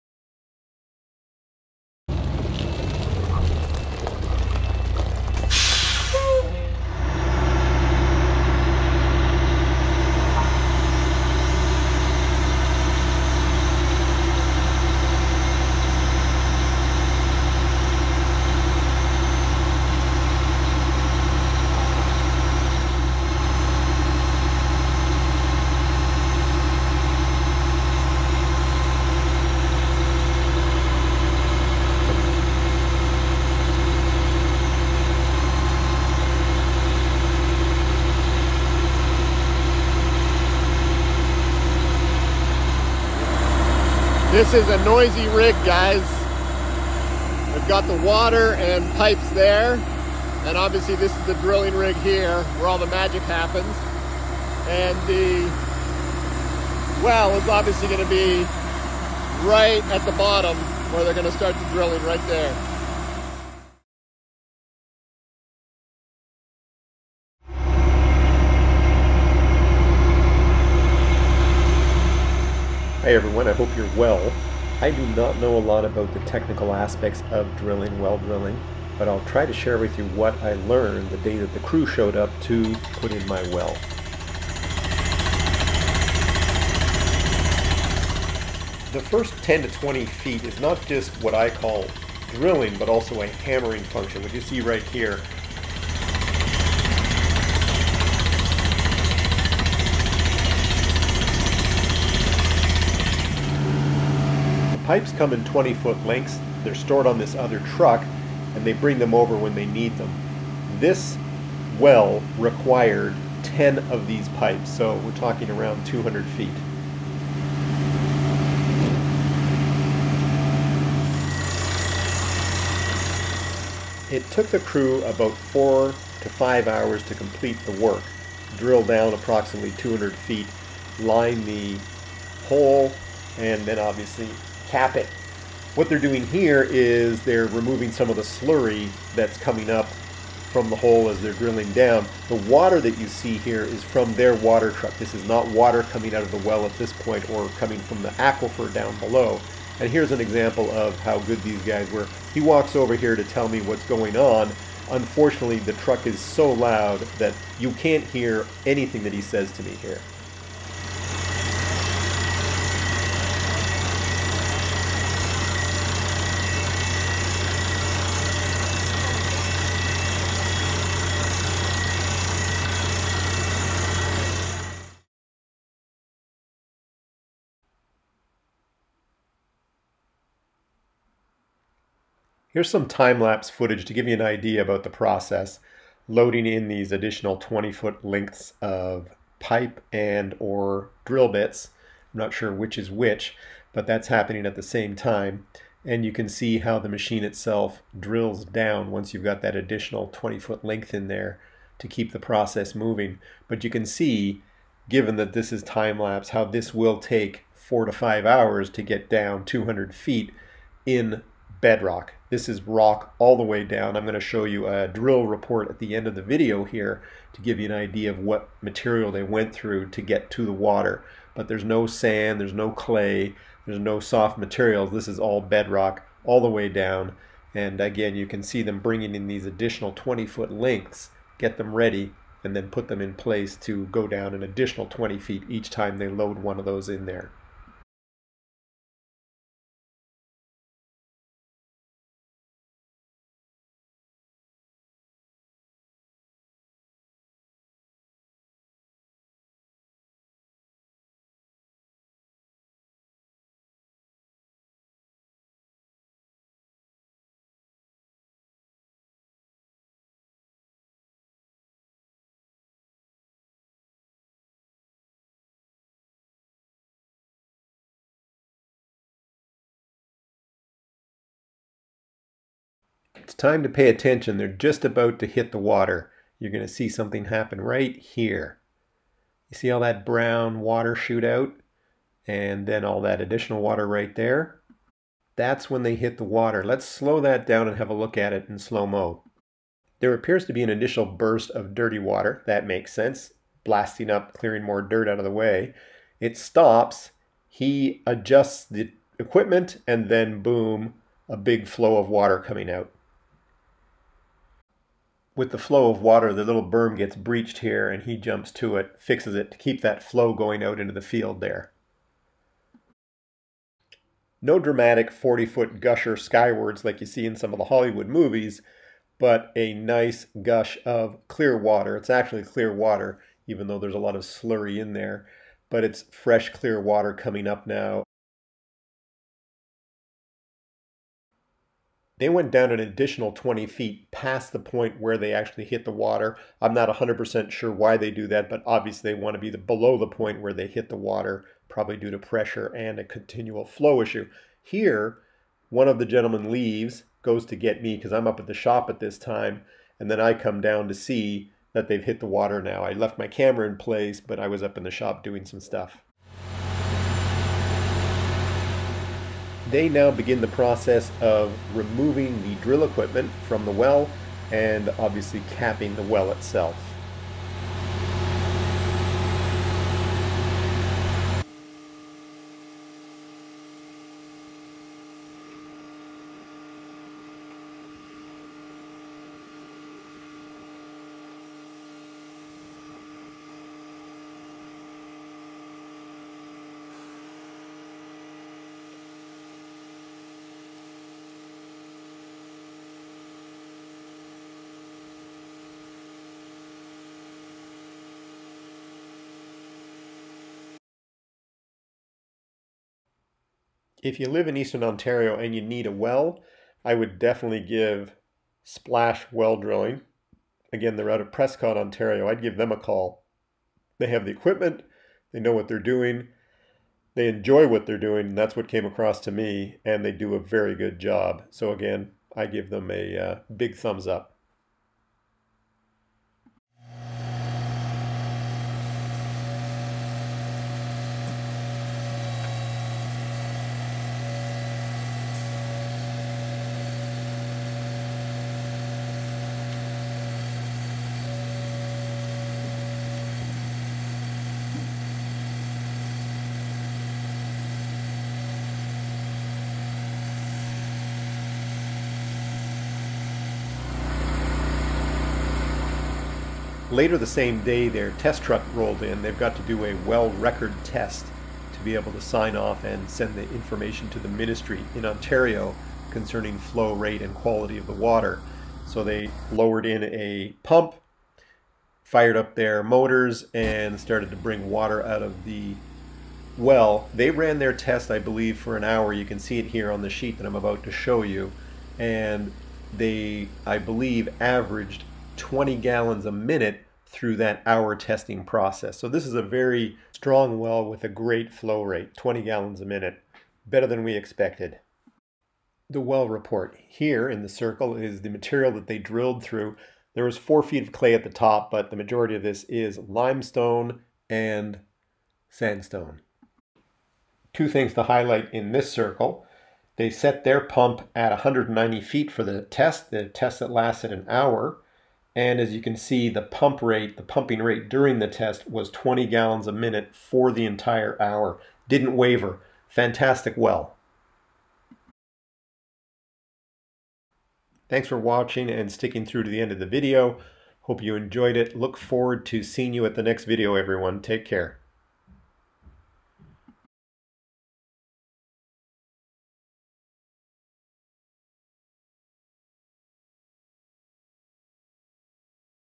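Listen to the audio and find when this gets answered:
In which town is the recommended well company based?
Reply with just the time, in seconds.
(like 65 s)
411 s.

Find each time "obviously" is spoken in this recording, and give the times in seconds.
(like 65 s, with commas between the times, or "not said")
50 s, 57 s, 133 s, 338 s, 364 s.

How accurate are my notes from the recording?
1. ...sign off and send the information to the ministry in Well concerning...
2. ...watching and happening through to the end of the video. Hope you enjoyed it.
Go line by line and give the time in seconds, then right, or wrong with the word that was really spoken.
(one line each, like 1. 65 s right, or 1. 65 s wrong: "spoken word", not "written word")
1. 462 s wrong: "Ontario", not "Well"
2. 528 s wrong: "sticking", not "happening".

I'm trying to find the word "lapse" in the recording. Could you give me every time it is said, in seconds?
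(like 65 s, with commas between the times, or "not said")
182 s, 205 s.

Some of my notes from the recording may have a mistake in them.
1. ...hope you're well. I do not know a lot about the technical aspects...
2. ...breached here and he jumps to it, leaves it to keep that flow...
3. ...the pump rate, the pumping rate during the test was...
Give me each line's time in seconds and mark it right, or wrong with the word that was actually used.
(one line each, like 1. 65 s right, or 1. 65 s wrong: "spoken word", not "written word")
1. 73 s right
2. 307 s wrong: "fixes", not "leaves"
3. 516 s right.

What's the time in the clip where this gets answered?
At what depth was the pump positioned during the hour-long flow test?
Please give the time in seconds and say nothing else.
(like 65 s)
511 s.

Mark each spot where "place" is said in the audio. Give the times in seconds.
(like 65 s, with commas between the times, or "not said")
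233 s, 353 s.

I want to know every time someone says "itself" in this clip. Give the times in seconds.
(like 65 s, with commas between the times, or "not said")
197 s, 366 s.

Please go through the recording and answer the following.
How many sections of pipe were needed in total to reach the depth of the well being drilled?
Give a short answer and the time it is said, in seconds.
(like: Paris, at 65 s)
10, at 113 s.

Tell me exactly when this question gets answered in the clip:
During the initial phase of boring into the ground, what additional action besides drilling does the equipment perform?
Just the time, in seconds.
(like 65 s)
93 s.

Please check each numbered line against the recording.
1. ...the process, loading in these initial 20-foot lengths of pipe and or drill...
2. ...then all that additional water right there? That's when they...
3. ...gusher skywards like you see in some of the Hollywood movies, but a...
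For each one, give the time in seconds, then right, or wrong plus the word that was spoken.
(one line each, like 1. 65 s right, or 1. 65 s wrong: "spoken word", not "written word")
1. 184 s wrong: "additional", not "initial"
2. 282 s right
3. 315 s right.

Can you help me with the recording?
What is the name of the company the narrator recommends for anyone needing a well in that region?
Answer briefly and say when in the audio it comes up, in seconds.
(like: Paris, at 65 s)
Splash Well Drilling, at 408 s.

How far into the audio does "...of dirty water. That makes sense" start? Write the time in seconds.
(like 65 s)
291 s.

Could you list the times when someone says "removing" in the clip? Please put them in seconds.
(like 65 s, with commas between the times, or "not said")
137 s, 361 s.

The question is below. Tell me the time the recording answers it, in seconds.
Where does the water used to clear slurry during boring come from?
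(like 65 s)
144 s.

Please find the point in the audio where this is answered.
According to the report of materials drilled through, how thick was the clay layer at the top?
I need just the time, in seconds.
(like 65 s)
500 s.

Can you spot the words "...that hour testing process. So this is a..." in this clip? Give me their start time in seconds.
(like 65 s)
487 s.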